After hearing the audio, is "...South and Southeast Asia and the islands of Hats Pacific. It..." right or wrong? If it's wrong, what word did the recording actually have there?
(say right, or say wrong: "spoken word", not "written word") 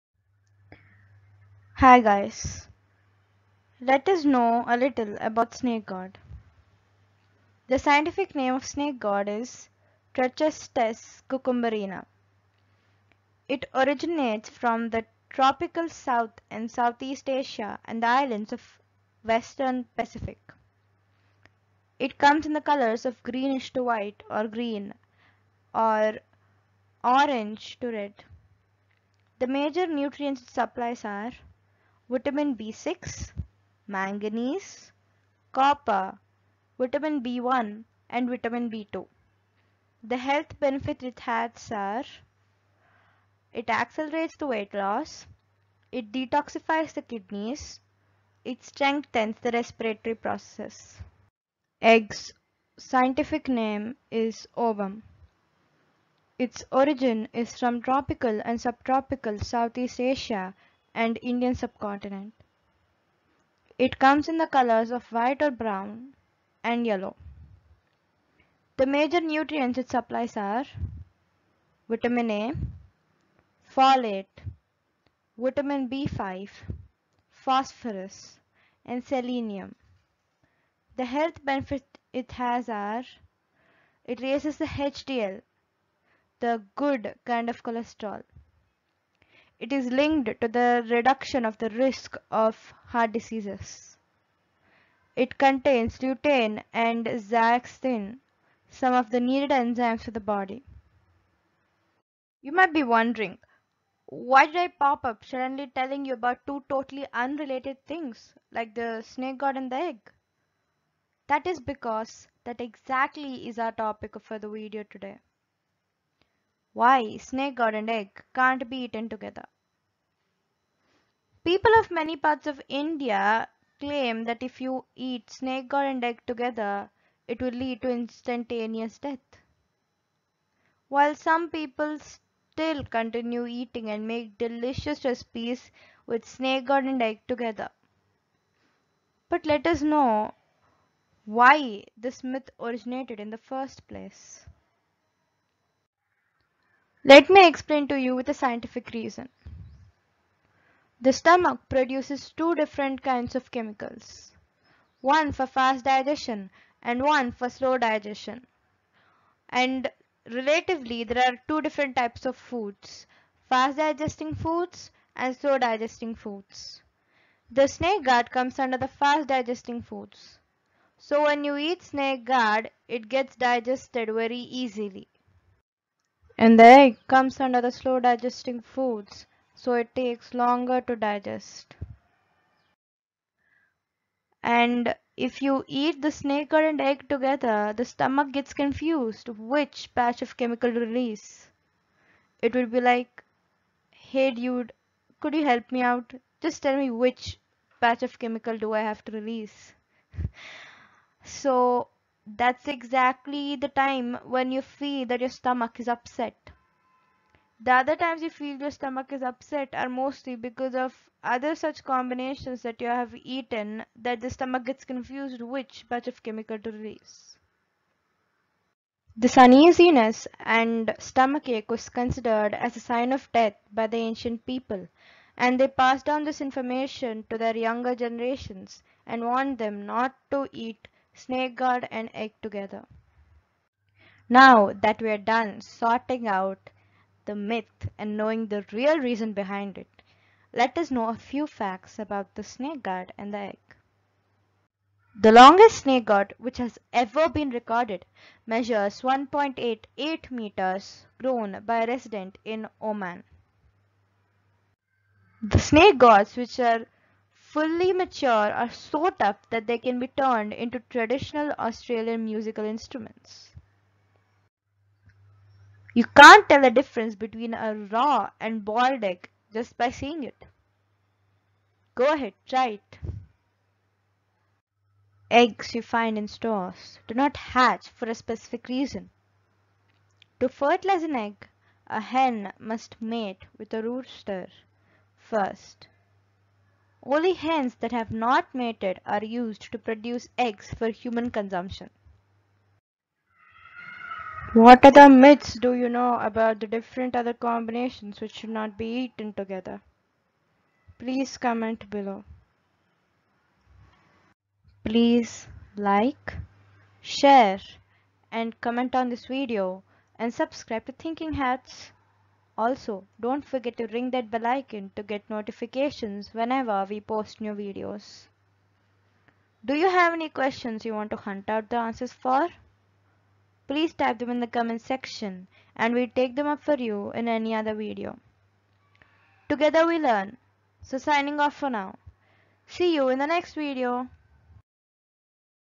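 wrong: "Western", not "Hats".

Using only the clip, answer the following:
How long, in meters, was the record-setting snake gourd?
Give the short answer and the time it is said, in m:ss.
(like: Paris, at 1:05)
1.88 meters, at 4:09.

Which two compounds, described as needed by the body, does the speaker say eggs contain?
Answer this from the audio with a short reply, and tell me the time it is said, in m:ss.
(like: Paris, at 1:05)
lutein and zeaxanthin, at 1:35.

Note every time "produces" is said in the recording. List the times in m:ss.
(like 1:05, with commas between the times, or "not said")
2:31, 4:49.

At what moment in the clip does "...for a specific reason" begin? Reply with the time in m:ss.
4:37.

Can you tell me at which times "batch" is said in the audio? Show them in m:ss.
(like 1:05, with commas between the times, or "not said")
3:09, 3:17, 3:35.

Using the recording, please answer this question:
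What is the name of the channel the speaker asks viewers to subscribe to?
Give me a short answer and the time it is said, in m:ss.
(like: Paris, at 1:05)
Thinking Hats, at 5:10.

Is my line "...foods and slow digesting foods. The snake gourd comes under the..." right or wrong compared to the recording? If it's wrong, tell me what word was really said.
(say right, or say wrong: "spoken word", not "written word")
right.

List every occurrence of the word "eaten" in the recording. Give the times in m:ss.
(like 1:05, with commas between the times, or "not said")
1:58, 3:33, 4:58.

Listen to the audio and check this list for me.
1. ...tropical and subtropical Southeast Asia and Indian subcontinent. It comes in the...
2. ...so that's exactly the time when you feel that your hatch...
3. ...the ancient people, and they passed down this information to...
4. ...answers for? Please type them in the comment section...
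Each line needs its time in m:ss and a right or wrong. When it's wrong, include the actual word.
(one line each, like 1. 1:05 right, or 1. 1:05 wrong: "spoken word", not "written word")
1. 0:57 right
2. 3:21 wrong: "stomach", not "hatch"
3. 3:43 right
4. 5:21 right.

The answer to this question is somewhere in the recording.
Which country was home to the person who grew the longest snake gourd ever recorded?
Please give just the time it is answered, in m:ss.
4:12.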